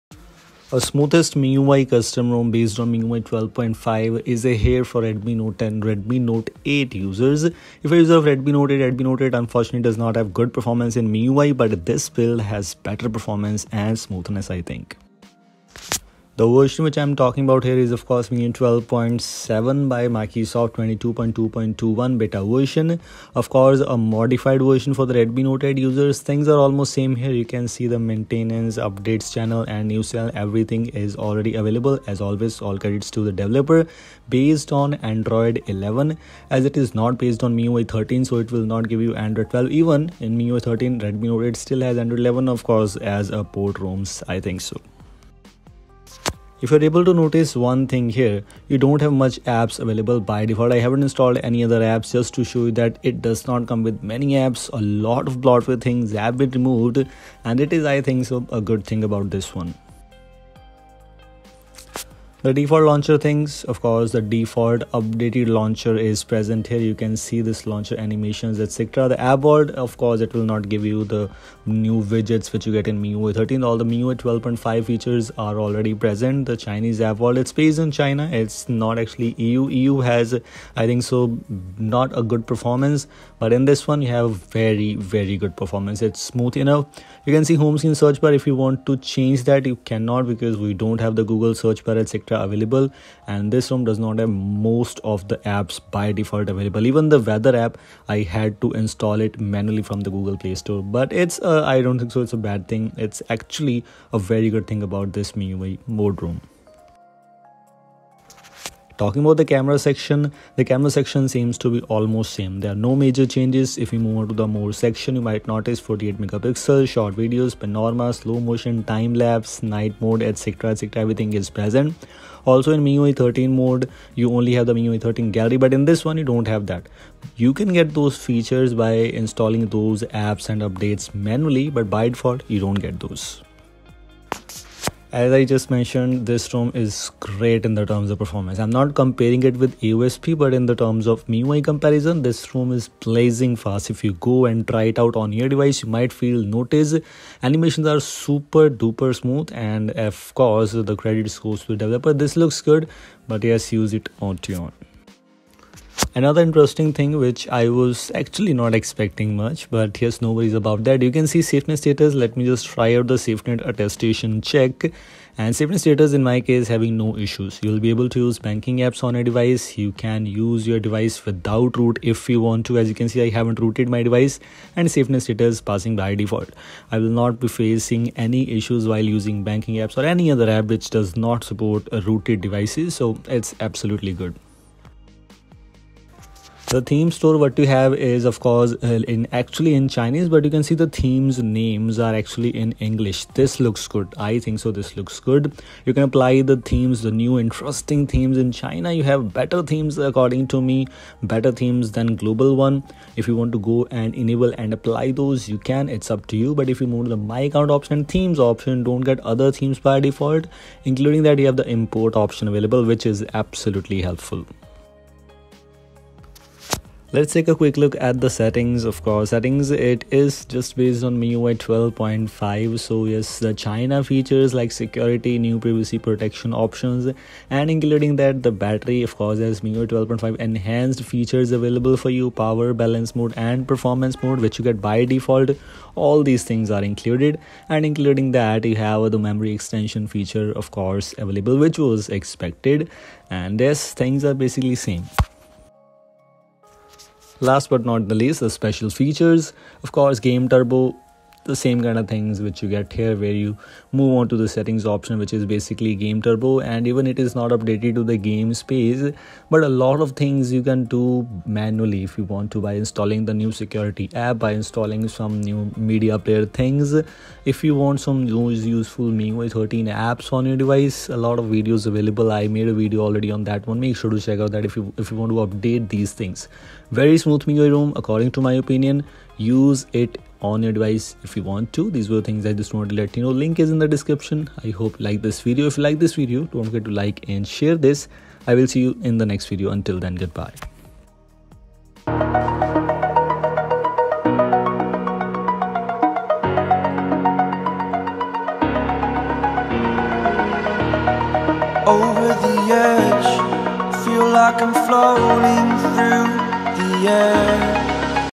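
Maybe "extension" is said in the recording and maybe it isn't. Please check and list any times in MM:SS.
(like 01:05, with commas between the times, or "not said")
03:59.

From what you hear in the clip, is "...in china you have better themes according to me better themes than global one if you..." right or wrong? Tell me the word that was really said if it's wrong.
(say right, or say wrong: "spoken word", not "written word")
right.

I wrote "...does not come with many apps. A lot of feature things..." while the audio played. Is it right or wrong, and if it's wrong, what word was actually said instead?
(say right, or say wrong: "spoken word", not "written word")
wrong: "bloatware", not "feature".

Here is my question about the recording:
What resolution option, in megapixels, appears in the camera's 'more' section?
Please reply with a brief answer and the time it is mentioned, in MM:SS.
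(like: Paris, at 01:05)
48, at 01:55.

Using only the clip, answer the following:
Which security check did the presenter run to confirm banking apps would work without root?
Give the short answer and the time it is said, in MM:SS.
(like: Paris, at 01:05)
SafetyNet attestation, at 02:43.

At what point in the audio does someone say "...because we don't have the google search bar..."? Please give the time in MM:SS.
01:30.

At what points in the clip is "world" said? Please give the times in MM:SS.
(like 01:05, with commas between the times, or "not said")
01:09, 01:17.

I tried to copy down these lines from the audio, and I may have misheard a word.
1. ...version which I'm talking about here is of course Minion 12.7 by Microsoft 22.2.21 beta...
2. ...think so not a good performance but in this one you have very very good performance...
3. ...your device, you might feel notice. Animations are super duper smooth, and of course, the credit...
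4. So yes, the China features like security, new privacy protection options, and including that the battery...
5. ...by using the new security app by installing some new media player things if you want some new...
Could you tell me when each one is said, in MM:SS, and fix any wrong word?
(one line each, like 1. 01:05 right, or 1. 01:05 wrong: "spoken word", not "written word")
1. 00:16 right
2. 01:20 right
3. 02:25 right
4. 03:42 right
5. 04:22 wrong: "installing", not "using".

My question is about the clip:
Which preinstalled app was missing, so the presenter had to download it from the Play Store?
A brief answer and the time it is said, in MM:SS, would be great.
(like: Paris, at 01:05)
weather app, at 01:37.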